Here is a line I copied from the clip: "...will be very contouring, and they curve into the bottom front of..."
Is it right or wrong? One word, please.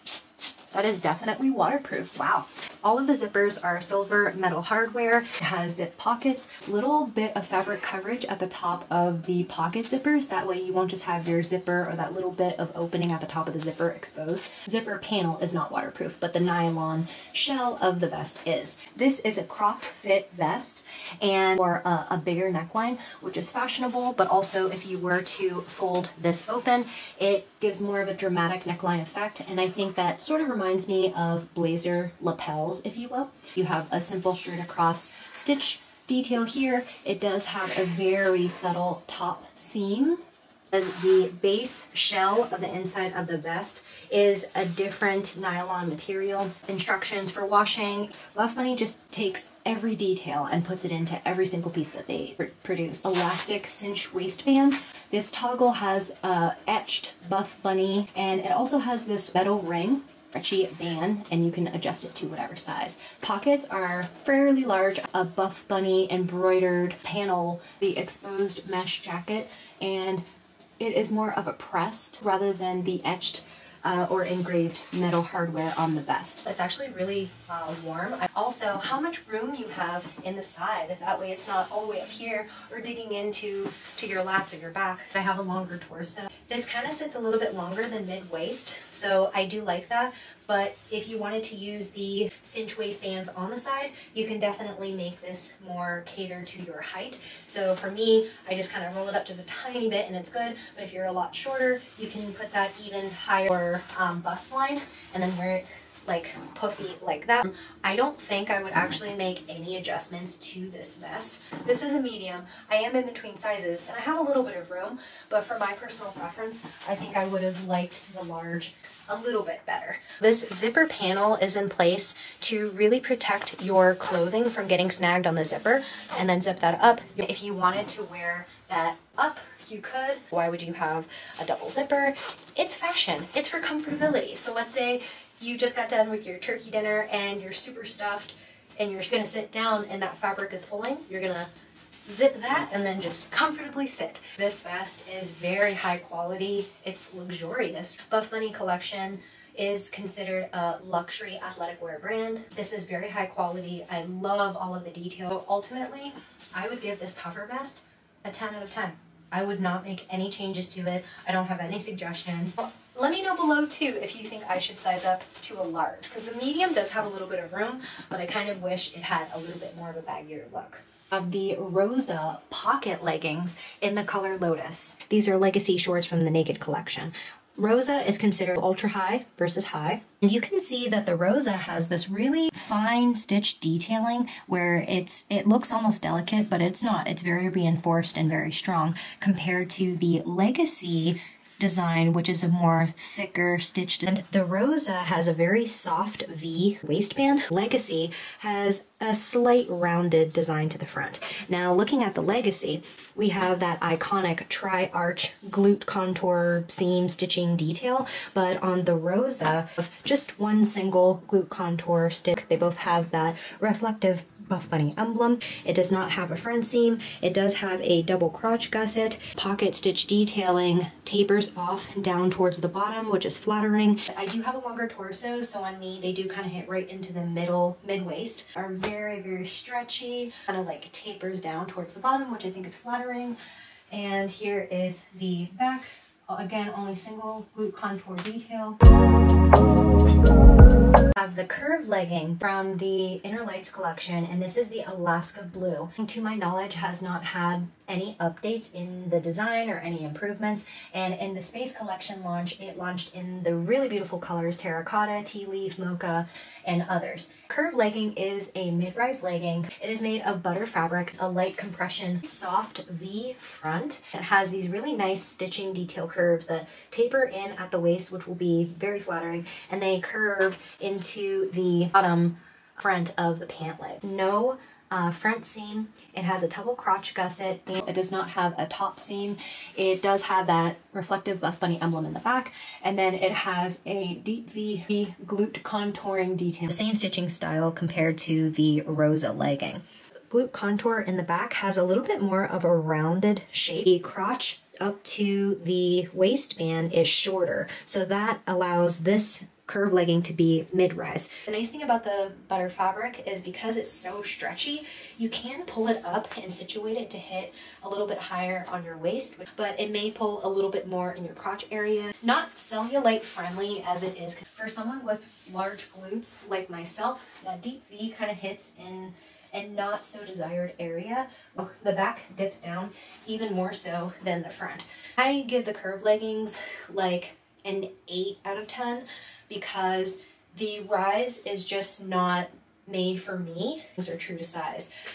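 wrong.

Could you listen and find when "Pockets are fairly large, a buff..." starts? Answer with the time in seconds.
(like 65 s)
63 s.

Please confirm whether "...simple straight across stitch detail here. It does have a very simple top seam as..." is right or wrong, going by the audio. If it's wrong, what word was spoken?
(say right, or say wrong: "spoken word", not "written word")
wrong: "subtle", not "simple".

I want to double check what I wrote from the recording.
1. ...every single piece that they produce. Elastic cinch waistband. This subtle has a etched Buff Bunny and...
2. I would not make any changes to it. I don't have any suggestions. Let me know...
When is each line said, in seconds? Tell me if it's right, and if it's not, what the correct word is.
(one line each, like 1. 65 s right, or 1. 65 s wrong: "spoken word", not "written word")
1. 51 s wrong: "toggle", not "subtle"
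2. 159 s right.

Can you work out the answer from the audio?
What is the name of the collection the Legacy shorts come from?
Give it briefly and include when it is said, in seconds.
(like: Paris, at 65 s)
Naked, at 176 s.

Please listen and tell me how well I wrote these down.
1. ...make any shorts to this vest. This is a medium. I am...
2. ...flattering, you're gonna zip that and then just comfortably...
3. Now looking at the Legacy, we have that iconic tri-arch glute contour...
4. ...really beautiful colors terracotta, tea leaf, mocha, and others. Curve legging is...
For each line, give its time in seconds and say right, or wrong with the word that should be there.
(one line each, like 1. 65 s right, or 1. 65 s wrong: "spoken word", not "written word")
1. 109 s wrong: "adjustments", not "shorts"
2. 140 s wrong: "pulling", not "flattering"
3. 201 s right
4. 253 s right.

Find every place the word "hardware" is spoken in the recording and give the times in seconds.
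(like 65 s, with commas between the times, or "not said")
4 s, 75 s.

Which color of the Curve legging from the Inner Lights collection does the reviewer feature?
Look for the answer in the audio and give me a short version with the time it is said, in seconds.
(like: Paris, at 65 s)
Alaska Blue, at 244 s.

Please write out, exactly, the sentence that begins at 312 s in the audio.
Not cellulite friendly as it is.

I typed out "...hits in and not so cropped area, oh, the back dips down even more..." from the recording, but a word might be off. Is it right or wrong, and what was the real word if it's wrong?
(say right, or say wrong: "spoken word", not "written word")
wrong: "desired", not "cropped".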